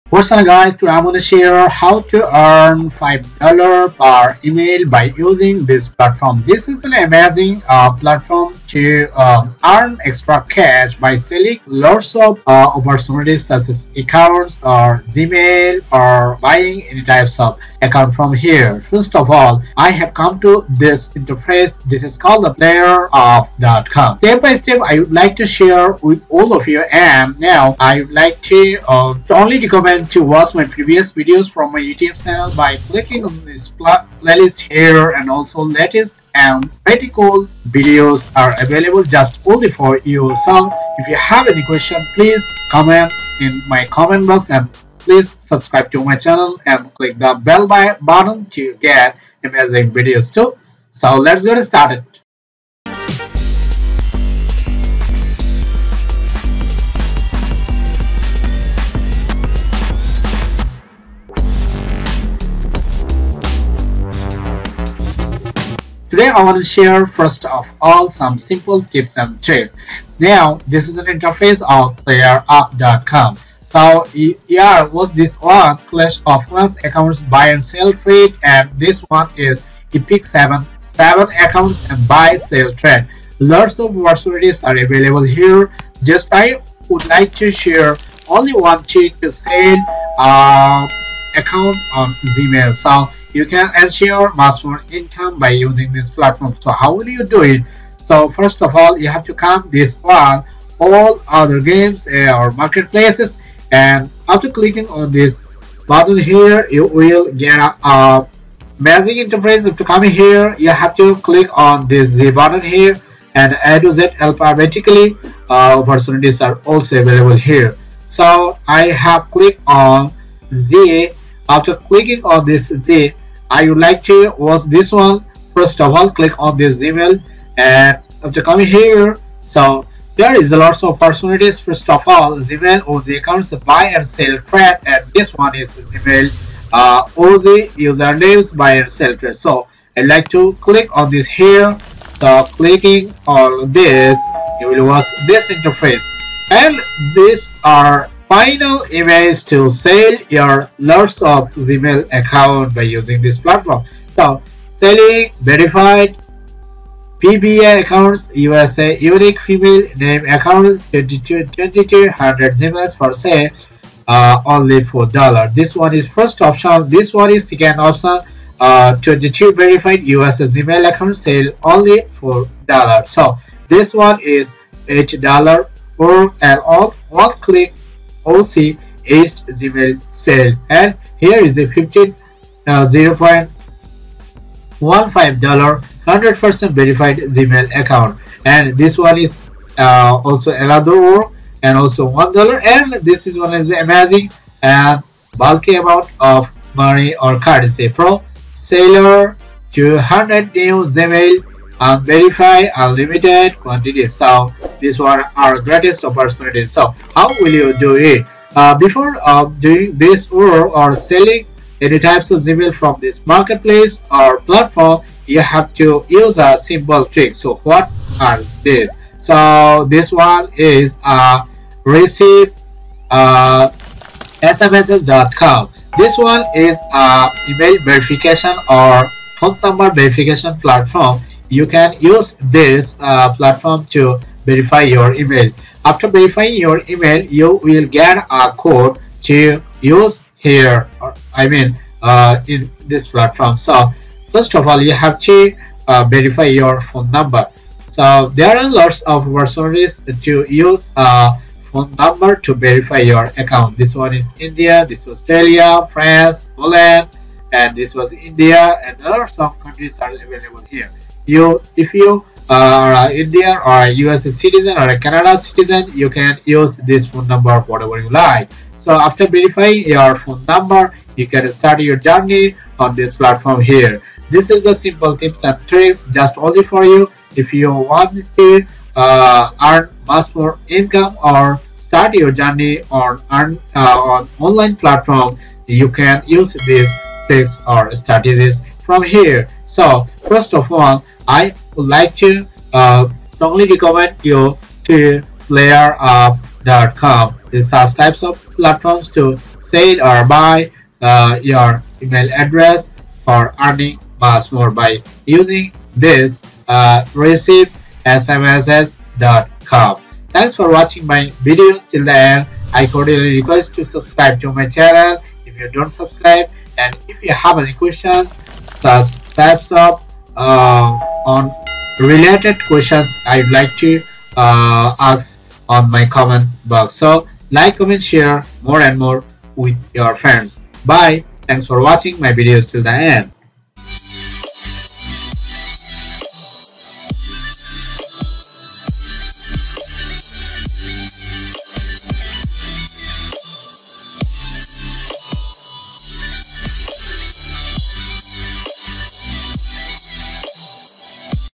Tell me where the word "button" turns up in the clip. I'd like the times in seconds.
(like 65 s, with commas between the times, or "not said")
47 s, 105 s, 112 s.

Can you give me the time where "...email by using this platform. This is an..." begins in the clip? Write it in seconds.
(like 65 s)
4 s.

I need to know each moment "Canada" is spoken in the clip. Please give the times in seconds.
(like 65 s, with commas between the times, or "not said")
264 s.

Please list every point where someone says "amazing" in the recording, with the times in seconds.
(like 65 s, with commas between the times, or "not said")
6 s, 49 s, 193 s.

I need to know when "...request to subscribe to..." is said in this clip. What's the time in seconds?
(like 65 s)
313 s.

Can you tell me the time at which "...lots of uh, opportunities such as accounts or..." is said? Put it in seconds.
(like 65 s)
11 s.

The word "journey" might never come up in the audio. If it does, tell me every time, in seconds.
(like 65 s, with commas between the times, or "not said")
271 s, 282 s.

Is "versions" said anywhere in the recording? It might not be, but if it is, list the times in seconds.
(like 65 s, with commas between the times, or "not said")
249 s.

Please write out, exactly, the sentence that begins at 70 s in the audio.
Now this is an interface of playerup.com.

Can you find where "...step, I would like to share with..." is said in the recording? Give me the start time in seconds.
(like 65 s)
24 s.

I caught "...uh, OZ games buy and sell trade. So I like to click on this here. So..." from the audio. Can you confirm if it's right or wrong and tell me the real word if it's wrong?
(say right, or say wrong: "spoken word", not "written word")
wrong: "usernames", not "games".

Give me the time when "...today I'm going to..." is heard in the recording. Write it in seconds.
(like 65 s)
0 s.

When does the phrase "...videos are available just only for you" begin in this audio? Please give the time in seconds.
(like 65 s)
37 s.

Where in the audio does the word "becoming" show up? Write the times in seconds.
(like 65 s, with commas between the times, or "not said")
not said.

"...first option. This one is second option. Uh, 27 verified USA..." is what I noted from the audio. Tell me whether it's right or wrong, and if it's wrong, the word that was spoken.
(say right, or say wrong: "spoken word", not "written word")
wrong: "22", not "27".